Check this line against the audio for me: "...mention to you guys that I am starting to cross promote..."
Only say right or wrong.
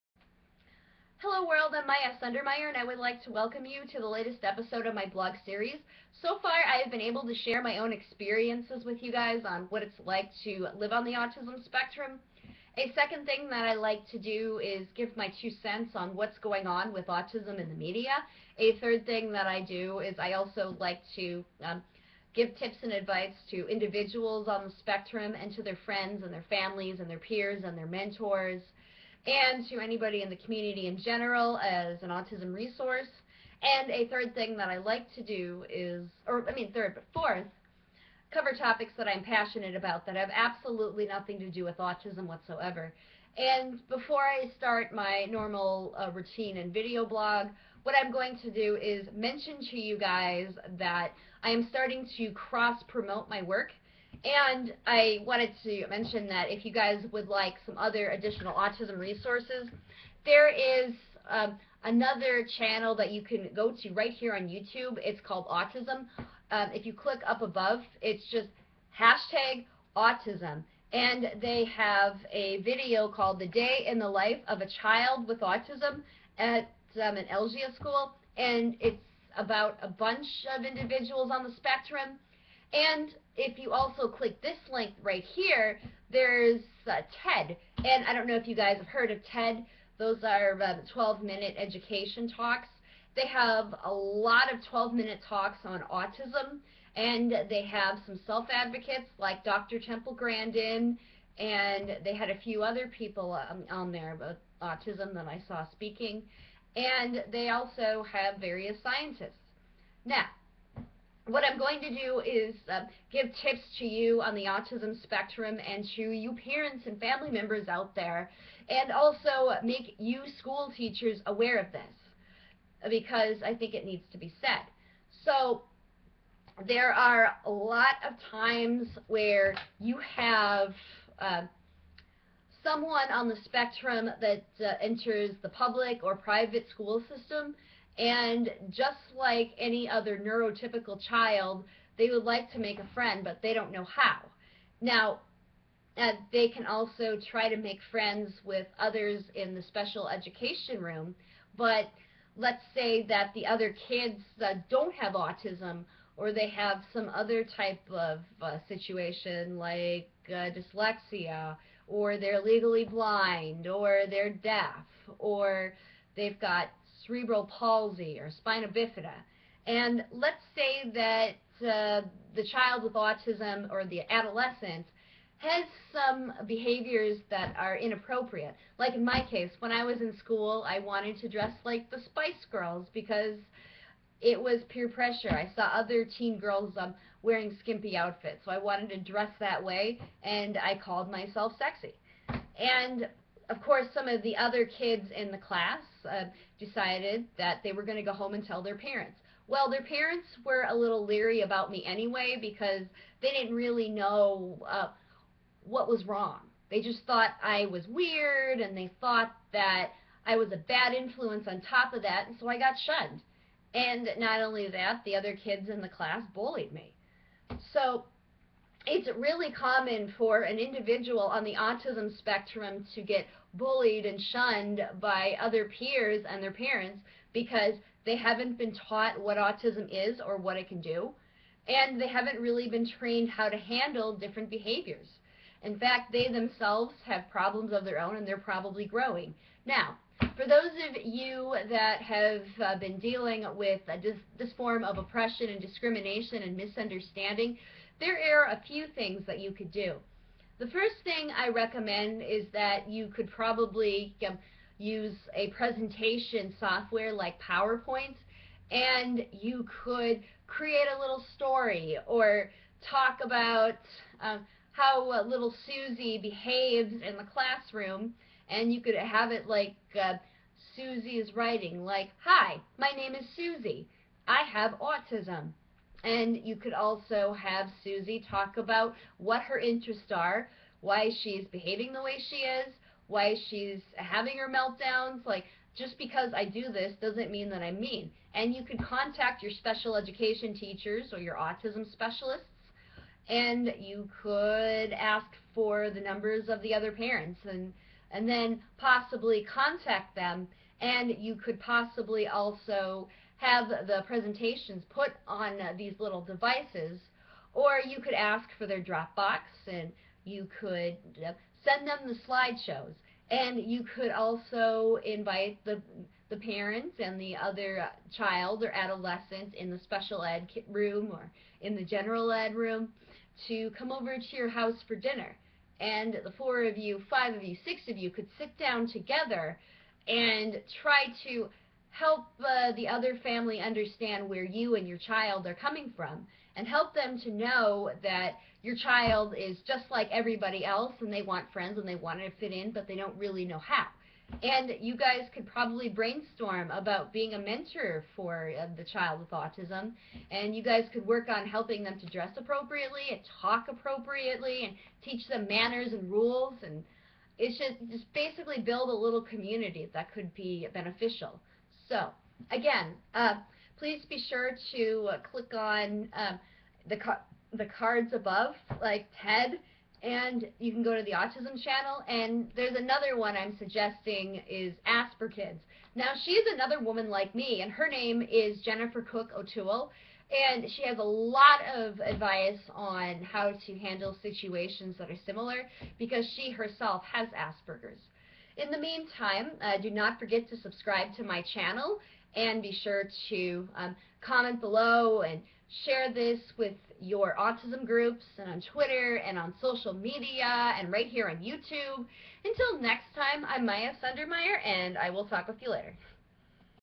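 right.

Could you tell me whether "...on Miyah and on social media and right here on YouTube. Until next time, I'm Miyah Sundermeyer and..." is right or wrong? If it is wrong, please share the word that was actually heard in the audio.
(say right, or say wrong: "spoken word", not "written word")
wrong: "Twitter", not "Miyah".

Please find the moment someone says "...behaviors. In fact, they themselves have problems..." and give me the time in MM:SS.
03:54.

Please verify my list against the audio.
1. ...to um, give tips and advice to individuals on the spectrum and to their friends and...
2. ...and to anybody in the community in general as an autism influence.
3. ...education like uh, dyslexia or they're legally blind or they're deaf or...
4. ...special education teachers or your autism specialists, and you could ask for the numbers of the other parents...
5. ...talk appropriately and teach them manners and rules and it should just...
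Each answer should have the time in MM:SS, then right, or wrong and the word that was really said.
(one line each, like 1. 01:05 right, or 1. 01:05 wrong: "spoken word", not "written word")
1. 00:21 right
2. 00:29 wrong: "resource", not "influence"
3. 02:38 wrong: "situation", not "education"
4. 04:49 right
5. 05:53 right.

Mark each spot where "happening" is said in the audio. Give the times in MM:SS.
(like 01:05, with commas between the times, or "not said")
not said.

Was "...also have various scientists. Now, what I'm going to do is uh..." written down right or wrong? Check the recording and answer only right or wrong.
right.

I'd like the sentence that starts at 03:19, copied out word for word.
Well, their parents were a little leery about me anyway because they didn't really know uh, what was wrong.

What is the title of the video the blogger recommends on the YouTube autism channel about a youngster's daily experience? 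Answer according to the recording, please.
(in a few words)
The Day in the Life of a Child with Autism.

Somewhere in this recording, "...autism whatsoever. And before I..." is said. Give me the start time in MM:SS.
00:41.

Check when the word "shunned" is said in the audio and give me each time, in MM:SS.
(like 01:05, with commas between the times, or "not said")
03:32, 03:44.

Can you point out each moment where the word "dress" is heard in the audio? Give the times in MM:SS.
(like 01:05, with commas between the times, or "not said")
03:01, 03:09, 05:52.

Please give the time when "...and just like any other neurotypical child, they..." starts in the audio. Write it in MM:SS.
02:18.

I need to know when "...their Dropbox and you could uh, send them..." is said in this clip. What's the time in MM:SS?
05:08.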